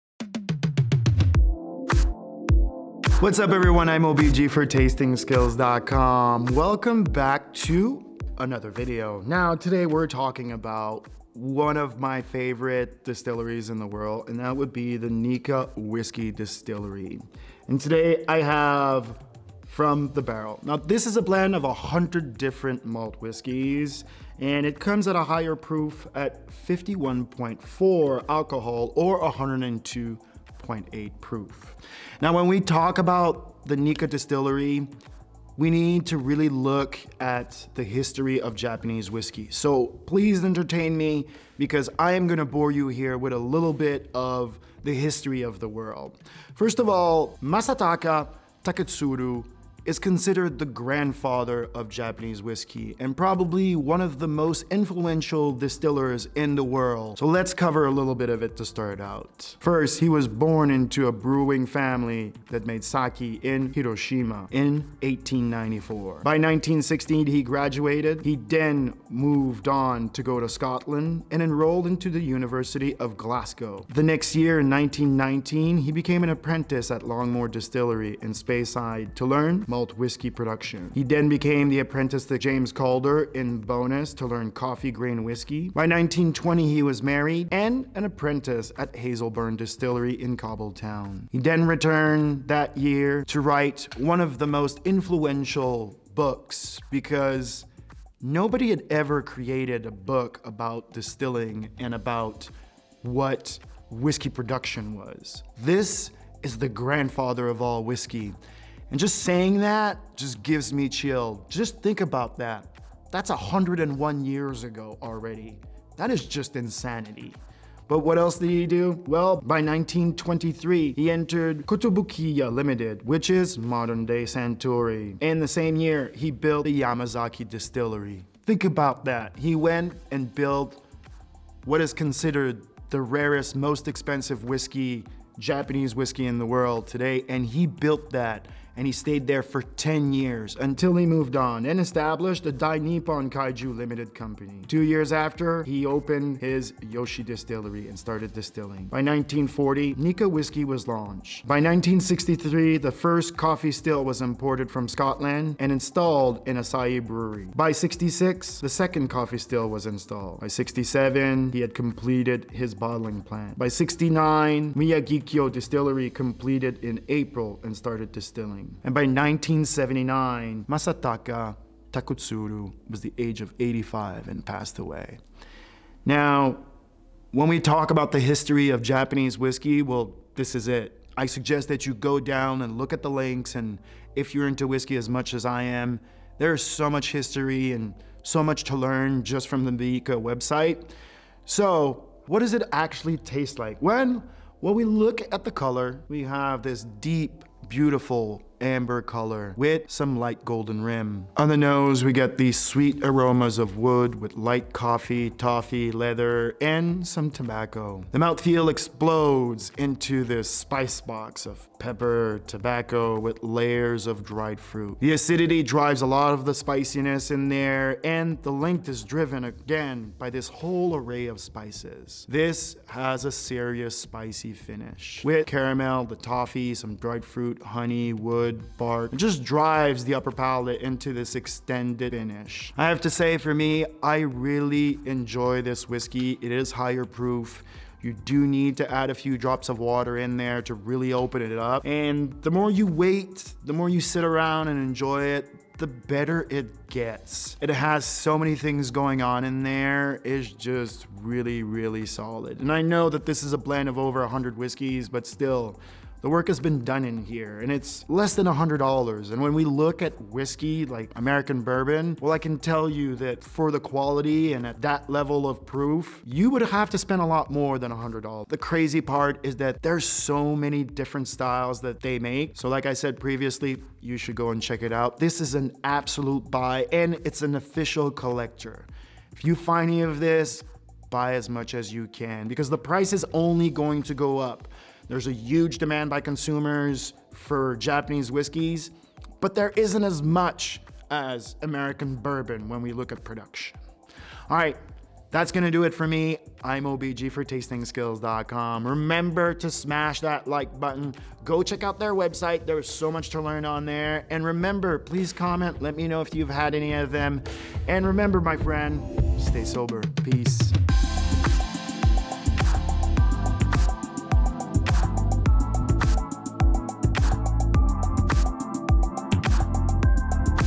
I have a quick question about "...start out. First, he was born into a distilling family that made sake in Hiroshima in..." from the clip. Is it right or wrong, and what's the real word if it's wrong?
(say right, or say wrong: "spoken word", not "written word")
wrong: "brewing", not "distilling".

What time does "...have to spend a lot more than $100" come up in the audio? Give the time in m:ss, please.
4:26.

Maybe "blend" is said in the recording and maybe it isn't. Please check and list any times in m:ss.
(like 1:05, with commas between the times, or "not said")
0:21, 4:13.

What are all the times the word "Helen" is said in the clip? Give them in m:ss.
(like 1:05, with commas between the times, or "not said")
not said.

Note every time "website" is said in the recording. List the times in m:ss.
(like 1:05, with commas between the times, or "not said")
3:10, 5:02.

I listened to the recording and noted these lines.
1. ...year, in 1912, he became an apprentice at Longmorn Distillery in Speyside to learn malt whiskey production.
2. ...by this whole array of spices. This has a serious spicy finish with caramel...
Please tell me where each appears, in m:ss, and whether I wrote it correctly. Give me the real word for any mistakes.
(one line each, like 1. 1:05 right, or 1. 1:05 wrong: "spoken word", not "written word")
1. 1:14 wrong: "1919", not "1912"
2. 3:40 right.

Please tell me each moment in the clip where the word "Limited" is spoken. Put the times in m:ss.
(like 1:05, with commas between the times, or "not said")
2:02, 2:23.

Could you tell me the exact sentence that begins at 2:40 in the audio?
By 67, he had completed his bottling plant.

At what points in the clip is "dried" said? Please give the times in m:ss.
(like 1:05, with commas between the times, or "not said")
3:34, 3:46.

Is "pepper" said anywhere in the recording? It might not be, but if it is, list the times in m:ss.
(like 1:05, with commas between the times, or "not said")
3:31.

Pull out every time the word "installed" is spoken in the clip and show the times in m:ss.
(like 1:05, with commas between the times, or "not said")
2:35, 2:39.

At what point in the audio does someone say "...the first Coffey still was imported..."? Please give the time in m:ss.
2:32.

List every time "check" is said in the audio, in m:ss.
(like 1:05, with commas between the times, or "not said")
4:34, 5:01.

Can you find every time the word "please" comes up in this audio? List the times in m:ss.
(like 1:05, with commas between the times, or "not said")
0:40, 5:04.